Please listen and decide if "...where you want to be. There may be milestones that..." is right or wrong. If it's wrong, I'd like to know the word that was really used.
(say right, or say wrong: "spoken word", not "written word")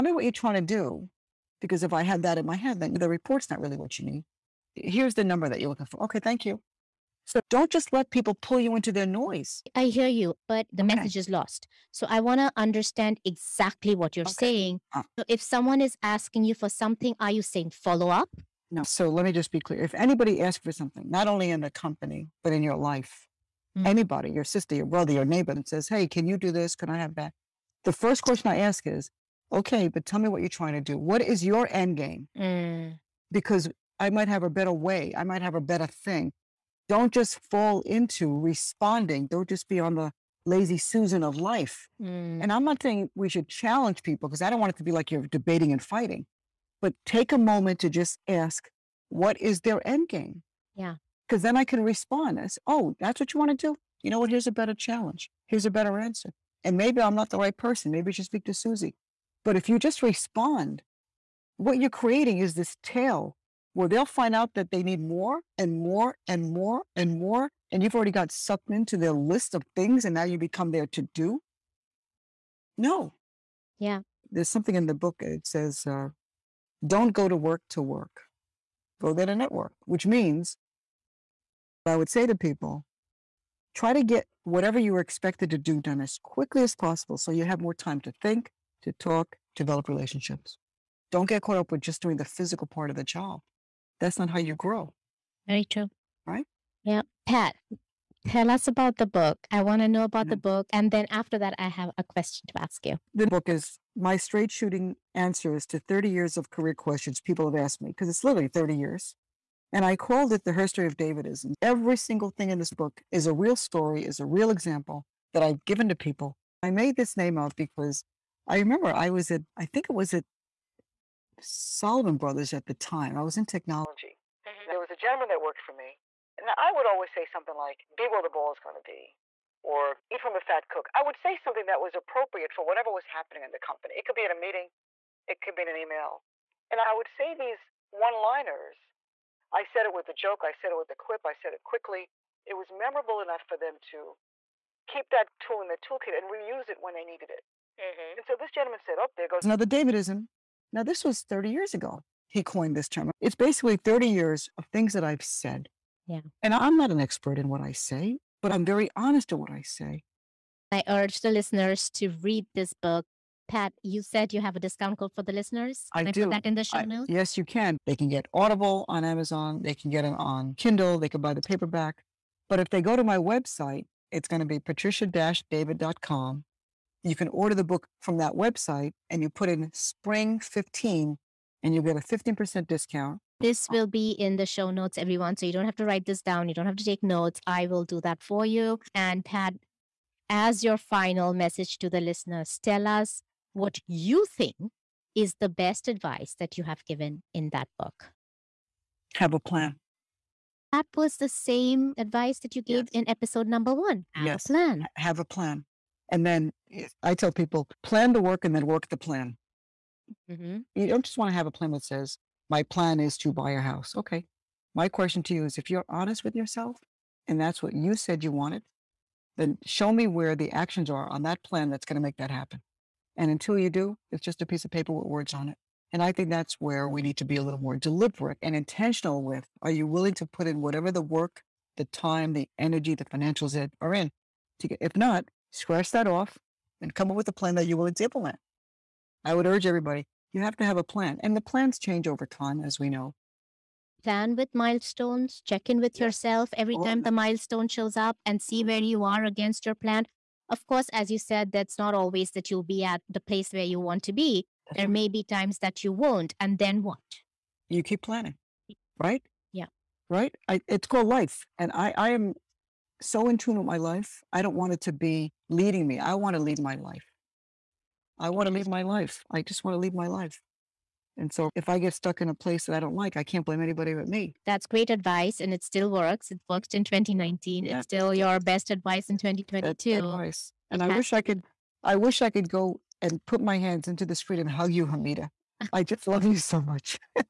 wrong: "times", not "milestones".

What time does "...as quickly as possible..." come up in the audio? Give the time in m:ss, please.
1:25.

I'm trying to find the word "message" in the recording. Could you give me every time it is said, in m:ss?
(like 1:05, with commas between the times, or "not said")
0:10, 3:11.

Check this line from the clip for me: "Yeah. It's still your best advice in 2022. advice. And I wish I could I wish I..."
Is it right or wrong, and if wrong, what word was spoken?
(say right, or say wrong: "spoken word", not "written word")
right.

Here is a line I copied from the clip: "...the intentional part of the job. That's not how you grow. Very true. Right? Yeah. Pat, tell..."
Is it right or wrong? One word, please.
wrong.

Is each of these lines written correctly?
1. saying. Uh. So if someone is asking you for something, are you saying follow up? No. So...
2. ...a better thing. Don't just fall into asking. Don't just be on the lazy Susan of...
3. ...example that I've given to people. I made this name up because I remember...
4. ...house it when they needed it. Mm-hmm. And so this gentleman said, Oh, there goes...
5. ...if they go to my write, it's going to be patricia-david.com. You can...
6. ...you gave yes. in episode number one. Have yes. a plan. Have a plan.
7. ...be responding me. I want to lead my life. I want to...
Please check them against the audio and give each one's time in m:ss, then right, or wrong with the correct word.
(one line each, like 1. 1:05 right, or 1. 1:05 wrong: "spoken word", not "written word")
1. 0:14 right
2. 0:35 wrong: "responding", not "asking"
3. 1:54 right
4. 2:26 wrong: "reuse", not "house"
5. 2:52 wrong: "website", not "write"
6. 3:22 right
7. 4:24 wrong: "leading", not "responding".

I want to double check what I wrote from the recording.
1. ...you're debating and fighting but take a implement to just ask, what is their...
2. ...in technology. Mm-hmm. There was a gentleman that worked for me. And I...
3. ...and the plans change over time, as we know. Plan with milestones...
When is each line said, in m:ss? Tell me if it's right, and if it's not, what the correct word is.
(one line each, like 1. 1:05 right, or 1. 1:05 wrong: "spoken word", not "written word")
1. 0:45 wrong: "moment", not "implement"
2. 2:03 right
3. 4:01 right.